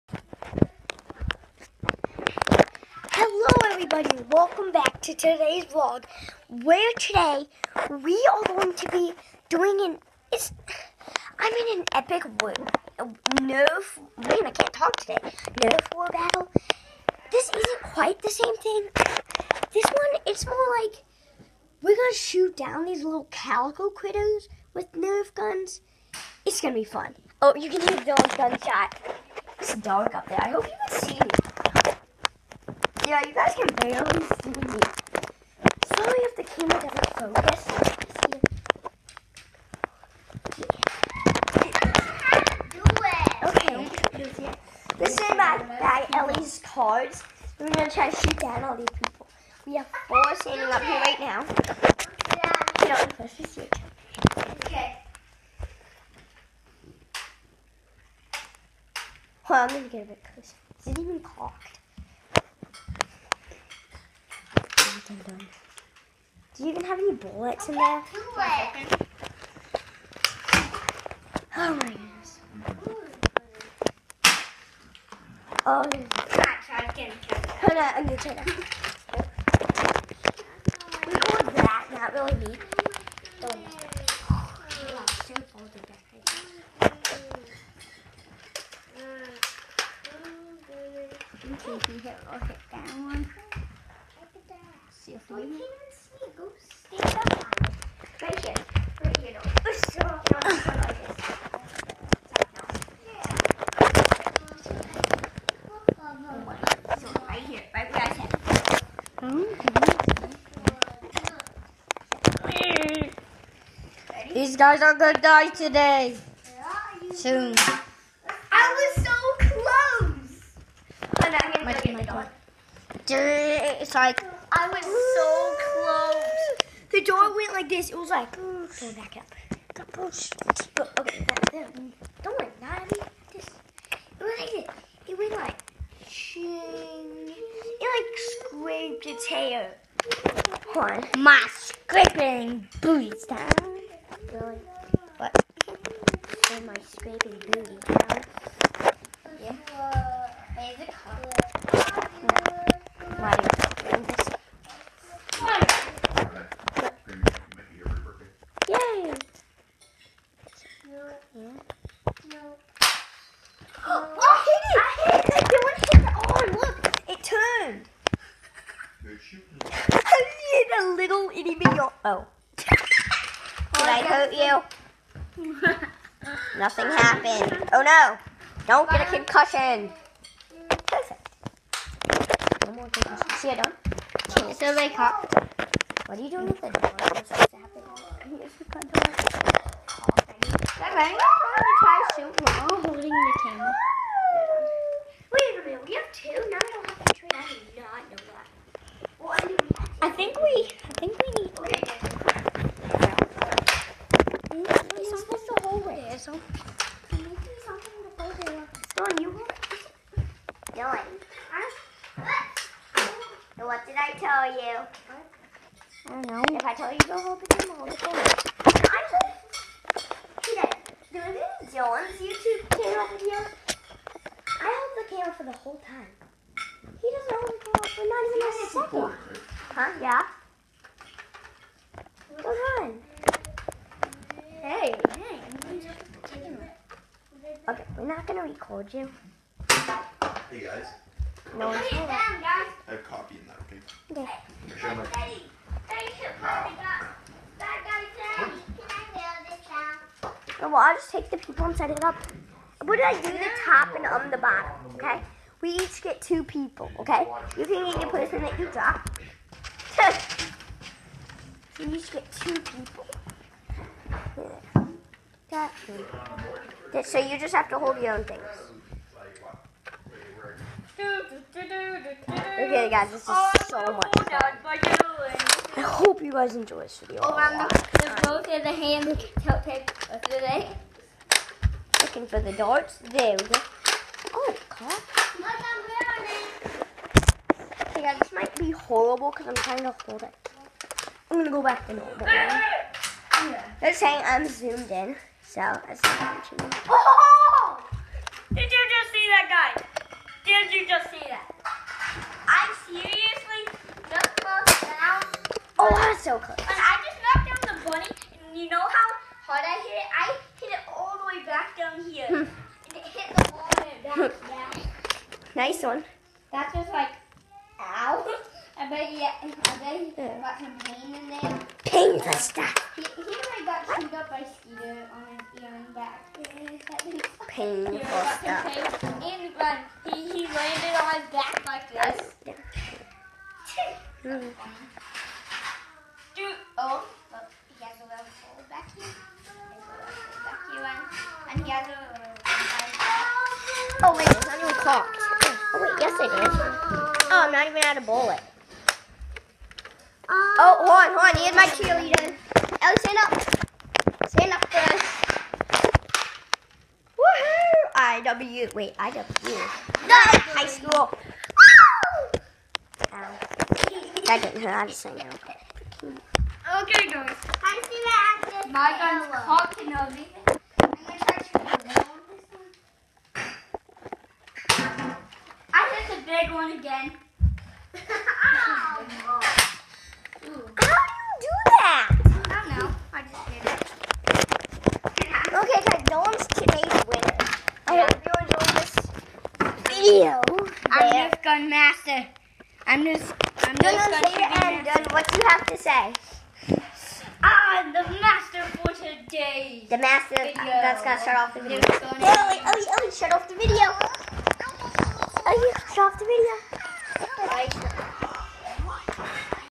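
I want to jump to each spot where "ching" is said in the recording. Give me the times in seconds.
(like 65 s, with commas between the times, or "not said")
136 s.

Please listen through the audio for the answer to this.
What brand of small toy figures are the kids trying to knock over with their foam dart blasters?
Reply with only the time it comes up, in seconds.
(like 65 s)
23 s.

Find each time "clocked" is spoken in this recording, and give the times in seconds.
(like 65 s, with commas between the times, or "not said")
61 s, 344 s.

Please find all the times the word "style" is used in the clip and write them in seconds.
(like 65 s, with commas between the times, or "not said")
143 s, 147 s.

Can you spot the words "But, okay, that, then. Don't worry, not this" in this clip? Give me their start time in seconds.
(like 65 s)
130 s.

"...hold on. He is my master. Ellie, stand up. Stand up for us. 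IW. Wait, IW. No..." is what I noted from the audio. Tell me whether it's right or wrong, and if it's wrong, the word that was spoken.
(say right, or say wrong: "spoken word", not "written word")
wrong: "cheerleader", not "master".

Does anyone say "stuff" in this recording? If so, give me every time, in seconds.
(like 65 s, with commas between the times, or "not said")
322 s, 328 s.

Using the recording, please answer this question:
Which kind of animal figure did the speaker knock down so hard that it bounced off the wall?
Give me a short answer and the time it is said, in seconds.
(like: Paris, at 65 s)
bunny, at 307 s.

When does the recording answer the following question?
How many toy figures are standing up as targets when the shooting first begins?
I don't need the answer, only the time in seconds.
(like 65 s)
50 s.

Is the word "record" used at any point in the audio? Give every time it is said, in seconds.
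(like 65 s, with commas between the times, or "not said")
76 s, 238 s.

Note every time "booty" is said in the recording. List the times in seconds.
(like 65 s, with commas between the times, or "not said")
142 s, 147 s.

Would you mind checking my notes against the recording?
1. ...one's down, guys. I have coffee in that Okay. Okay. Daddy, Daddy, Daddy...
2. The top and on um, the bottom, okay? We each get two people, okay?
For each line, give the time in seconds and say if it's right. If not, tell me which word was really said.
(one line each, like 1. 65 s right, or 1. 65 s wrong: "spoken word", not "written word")
1. 241 s right
2. 253 s right.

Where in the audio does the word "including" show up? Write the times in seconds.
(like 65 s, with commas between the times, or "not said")
not said.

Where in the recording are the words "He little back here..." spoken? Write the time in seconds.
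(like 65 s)
339 s.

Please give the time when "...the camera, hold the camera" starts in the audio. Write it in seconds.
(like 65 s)
217 s.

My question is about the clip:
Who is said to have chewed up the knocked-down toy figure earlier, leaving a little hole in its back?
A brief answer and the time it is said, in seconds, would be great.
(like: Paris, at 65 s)
Skeeter, at 324 s.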